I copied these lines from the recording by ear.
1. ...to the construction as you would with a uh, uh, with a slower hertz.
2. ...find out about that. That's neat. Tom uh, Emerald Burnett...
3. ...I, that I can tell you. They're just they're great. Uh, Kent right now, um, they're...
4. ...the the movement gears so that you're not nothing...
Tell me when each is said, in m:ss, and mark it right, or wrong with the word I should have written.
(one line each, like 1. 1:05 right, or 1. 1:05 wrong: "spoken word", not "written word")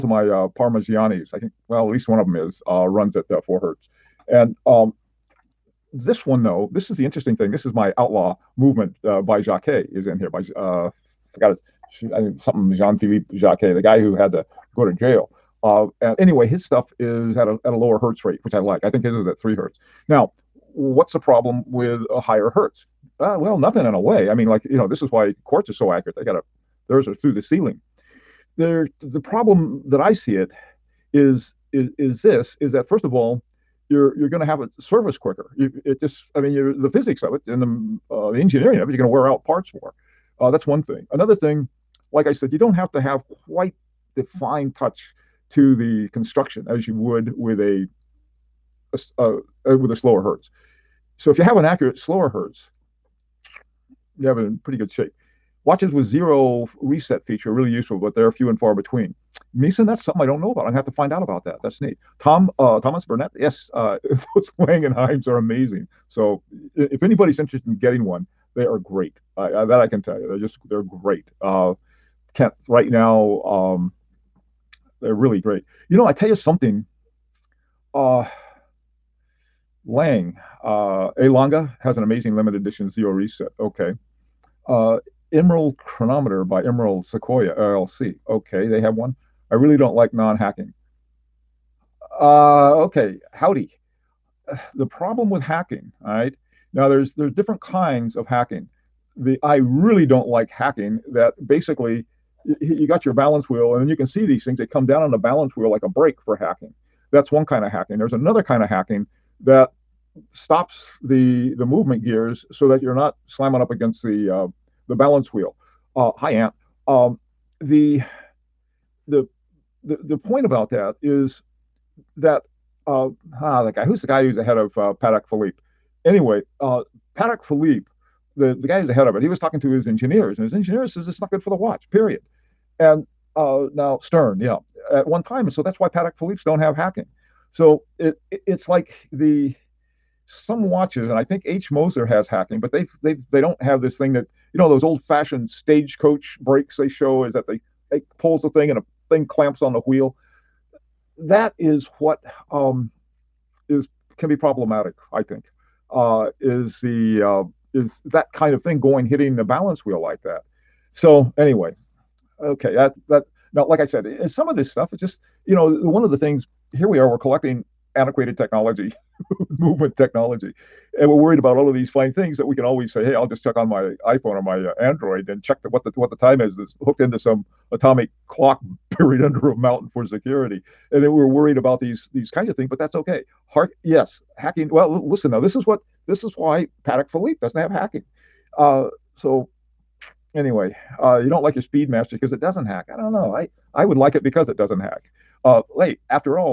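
1. 0:45 right
2. 1:00 wrong: "Thomas", not "Emerald"
3. 1:09 right
4. 1:51 wrong: "slamming", not "nothing".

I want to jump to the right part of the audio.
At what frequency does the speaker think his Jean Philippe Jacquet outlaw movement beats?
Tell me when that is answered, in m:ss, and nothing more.
0:19.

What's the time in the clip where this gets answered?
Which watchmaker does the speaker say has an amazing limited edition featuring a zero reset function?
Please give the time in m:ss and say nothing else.
1:21.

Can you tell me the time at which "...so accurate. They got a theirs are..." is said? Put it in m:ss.
0:25.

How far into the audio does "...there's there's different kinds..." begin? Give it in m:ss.
1:36.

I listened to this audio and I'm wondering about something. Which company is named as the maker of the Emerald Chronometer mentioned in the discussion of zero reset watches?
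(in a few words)
Emerald Sequoia LLC.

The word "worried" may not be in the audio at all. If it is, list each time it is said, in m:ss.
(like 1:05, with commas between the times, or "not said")
2:51, 3:01.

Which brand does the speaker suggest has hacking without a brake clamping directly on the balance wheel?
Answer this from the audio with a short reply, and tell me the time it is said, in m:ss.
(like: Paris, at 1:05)
H. Moser, at 2:21.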